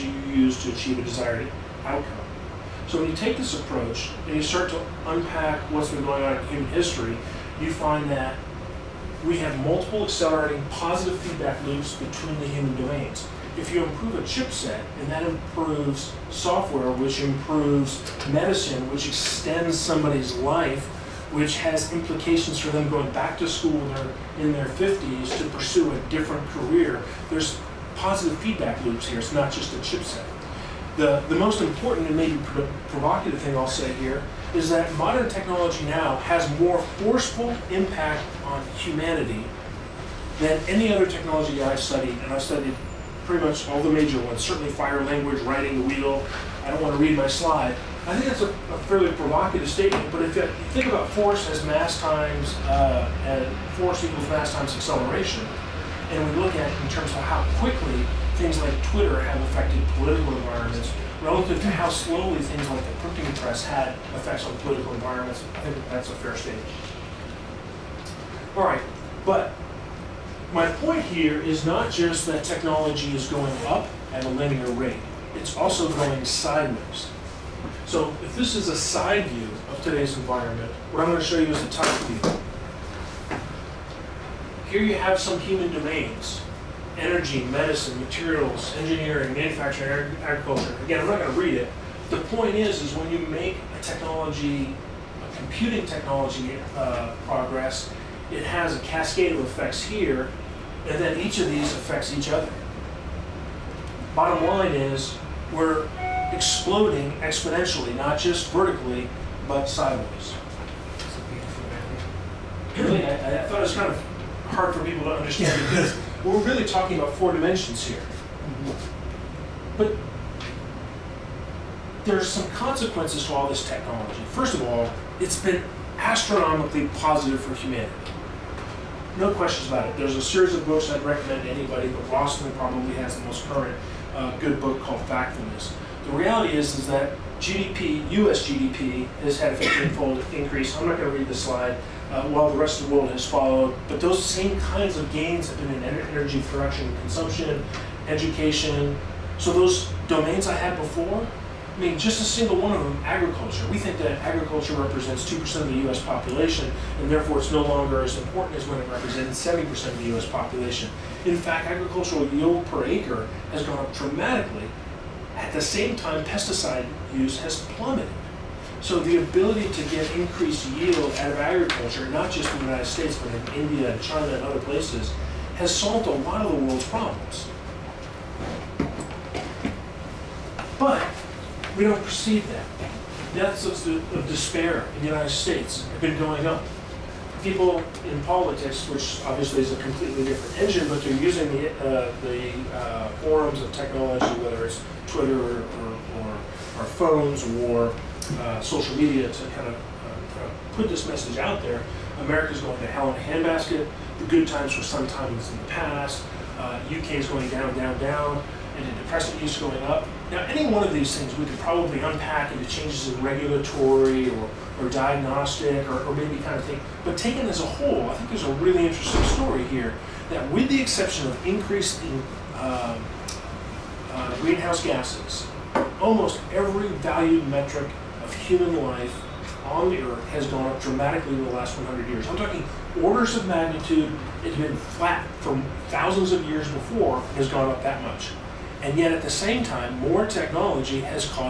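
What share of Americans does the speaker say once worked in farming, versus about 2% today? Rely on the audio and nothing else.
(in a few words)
70%.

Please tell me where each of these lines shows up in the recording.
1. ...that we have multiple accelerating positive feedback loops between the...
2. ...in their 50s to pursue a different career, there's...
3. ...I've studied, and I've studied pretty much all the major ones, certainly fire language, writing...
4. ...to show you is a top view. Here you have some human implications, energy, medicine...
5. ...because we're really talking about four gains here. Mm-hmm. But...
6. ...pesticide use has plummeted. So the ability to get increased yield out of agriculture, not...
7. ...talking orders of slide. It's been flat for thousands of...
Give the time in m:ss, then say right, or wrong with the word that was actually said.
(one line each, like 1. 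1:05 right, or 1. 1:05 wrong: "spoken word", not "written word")
1. 0:08 right
2. 0:24 right
3. 0:41 right
4. 1:21 wrong: "domains", not "implications"
5. 1:55 wrong: "dimensions", not "gains"
6. 2:46 right
7. 3:52 wrong: "magnitude", not "slide".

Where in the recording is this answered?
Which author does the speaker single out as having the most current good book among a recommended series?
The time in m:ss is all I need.
2:12.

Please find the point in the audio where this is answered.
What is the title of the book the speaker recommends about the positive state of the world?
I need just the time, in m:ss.
2:15.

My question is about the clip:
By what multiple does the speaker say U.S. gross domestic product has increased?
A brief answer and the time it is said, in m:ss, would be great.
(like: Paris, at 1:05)
15-fold, at 2:19.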